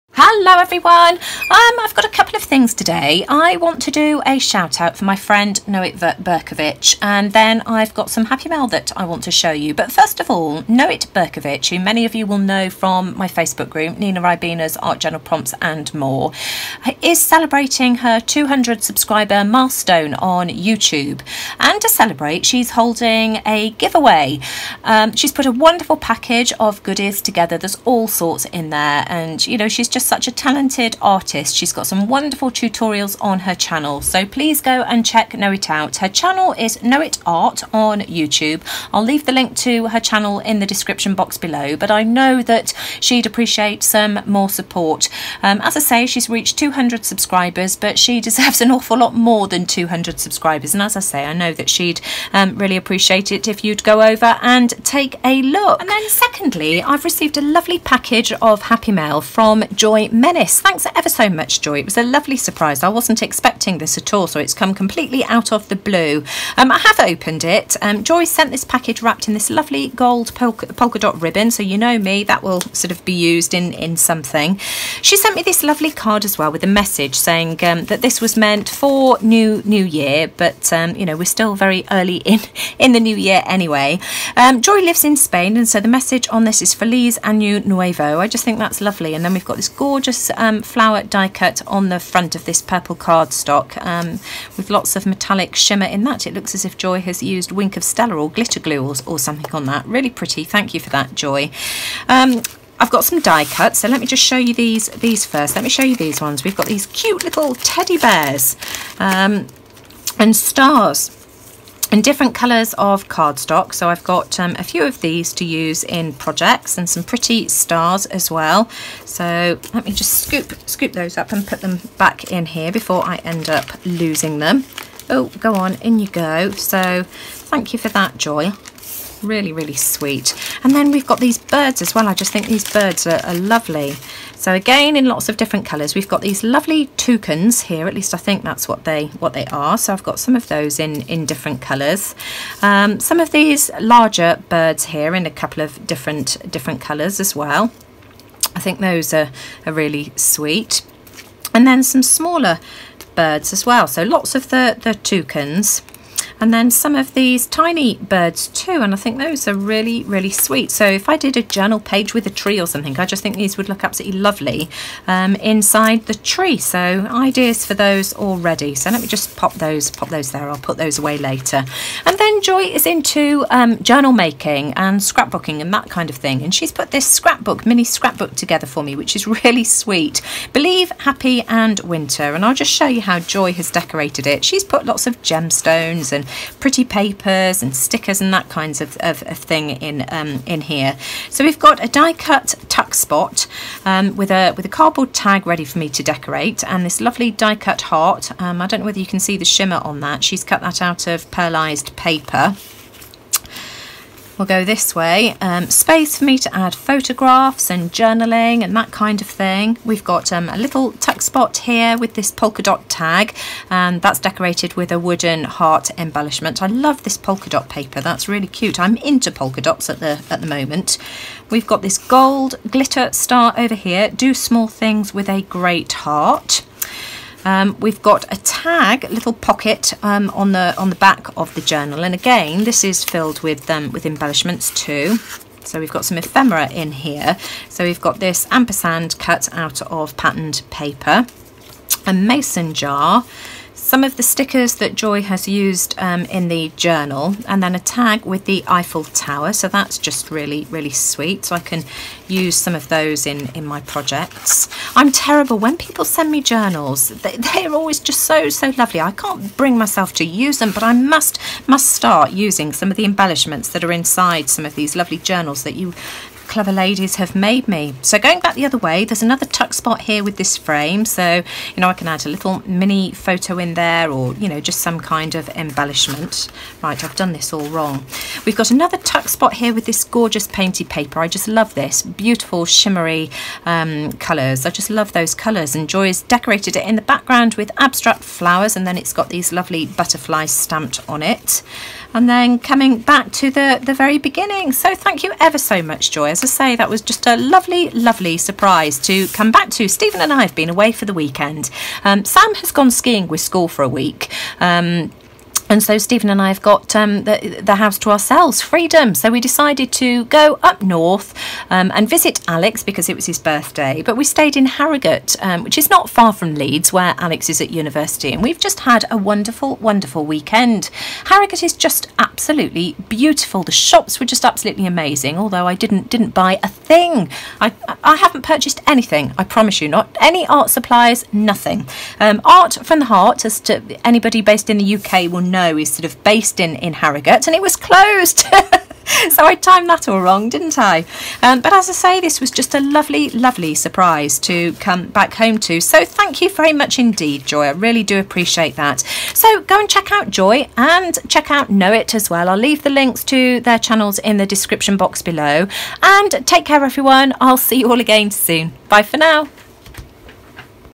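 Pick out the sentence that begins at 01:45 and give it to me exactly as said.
Let me show you these ones.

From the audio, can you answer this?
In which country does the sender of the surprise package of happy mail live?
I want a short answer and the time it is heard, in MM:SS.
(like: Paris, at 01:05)
Spain, at 01:25.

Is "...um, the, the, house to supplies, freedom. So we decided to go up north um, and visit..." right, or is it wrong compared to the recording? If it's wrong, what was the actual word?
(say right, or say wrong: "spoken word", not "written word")
wrong: "ourselves", not "supplies".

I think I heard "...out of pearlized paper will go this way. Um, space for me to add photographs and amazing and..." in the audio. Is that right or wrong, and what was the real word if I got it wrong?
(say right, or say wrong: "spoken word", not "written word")
wrong: "journaling", not "amazing".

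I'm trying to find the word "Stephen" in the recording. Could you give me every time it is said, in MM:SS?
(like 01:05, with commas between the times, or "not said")
04:59, 05:05.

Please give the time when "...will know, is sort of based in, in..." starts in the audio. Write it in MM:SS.
05:35.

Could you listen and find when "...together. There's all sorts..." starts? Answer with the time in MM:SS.
00:27.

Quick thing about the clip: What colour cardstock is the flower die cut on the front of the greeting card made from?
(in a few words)
purple.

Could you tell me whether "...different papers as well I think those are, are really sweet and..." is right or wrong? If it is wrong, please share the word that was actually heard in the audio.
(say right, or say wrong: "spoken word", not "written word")
wrong: "colors", not "papers".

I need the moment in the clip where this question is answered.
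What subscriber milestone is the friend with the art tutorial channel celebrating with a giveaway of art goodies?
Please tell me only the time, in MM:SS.
00:18.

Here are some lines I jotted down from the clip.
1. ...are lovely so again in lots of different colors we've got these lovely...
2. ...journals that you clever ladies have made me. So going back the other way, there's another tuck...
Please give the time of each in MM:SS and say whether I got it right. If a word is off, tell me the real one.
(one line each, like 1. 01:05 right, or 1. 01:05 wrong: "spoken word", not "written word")
1. 02:13 right
2. 04:25 right.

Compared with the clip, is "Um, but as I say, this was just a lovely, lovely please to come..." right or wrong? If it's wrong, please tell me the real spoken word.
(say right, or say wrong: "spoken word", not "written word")
wrong: "surprise", not "please".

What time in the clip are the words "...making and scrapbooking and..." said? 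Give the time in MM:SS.
02:54.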